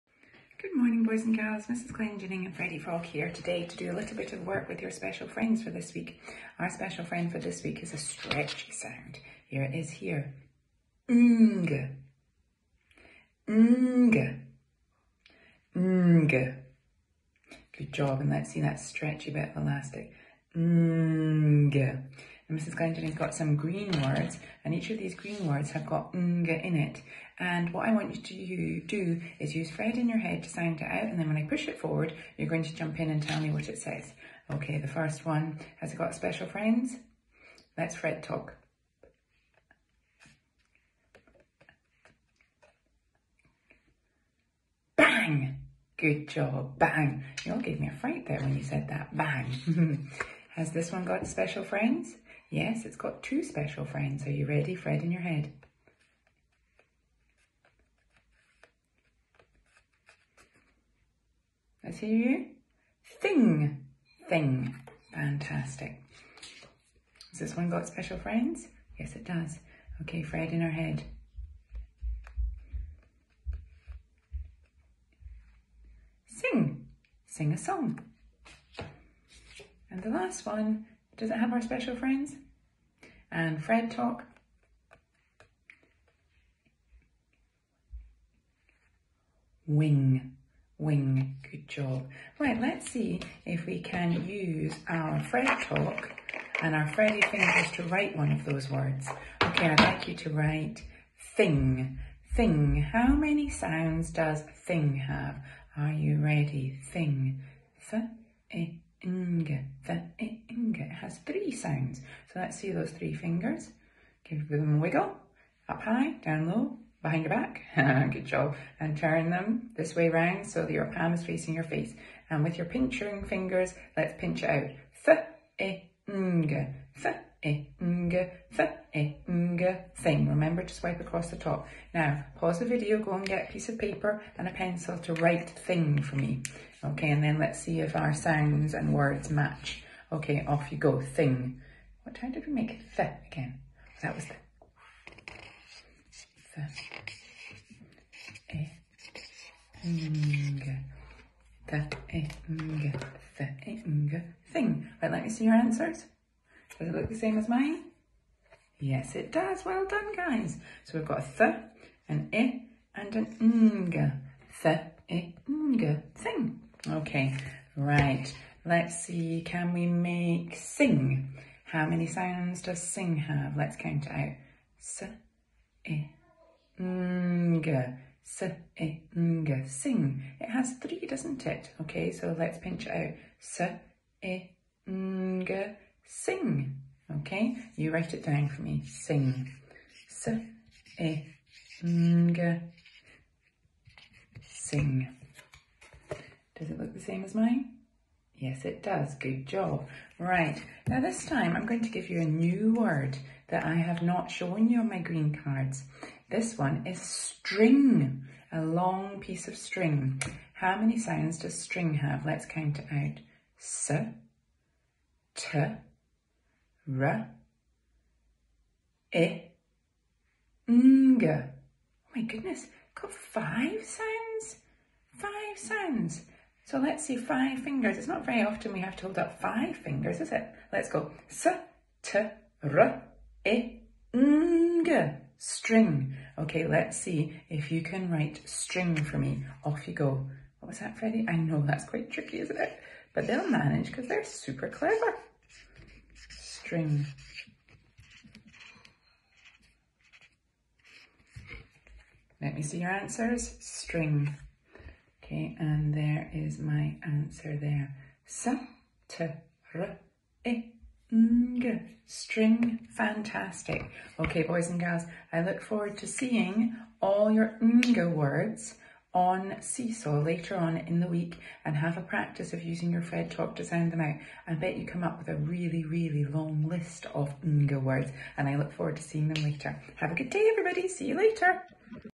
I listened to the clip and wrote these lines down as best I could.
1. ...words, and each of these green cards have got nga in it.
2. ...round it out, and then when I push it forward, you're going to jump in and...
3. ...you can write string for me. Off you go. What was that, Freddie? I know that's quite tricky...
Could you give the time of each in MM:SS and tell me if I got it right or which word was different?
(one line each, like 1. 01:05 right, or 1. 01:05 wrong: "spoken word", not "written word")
1. 00:24 wrong: "words", not "cards"
2. 00:30 wrong: "sound", not "round"
3. 03:57 right.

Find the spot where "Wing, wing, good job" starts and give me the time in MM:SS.
01:29.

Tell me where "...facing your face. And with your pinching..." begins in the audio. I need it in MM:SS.
02:01.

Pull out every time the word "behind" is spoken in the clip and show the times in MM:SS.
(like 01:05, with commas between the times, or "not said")
01:57.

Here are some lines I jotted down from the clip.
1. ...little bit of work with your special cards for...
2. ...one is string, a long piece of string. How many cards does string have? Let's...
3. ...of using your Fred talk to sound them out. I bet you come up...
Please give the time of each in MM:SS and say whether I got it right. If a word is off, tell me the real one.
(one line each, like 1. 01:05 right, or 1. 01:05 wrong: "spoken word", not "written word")
1. 00:03 wrong: "friends", not "cards"
2. 03:26 wrong: "sounds", not "cards"
3. 04:32 right.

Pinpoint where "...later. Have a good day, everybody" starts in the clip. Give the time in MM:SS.
04:39.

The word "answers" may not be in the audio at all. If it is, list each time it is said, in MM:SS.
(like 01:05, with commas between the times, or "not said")
02:35, 04:12, 04:17.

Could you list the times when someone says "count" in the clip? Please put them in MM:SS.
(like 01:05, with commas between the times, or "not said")
02:53, 03:32.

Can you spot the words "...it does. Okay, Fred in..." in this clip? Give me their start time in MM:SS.
01:09.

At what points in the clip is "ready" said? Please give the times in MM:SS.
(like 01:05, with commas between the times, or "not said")
00:54, 01:46.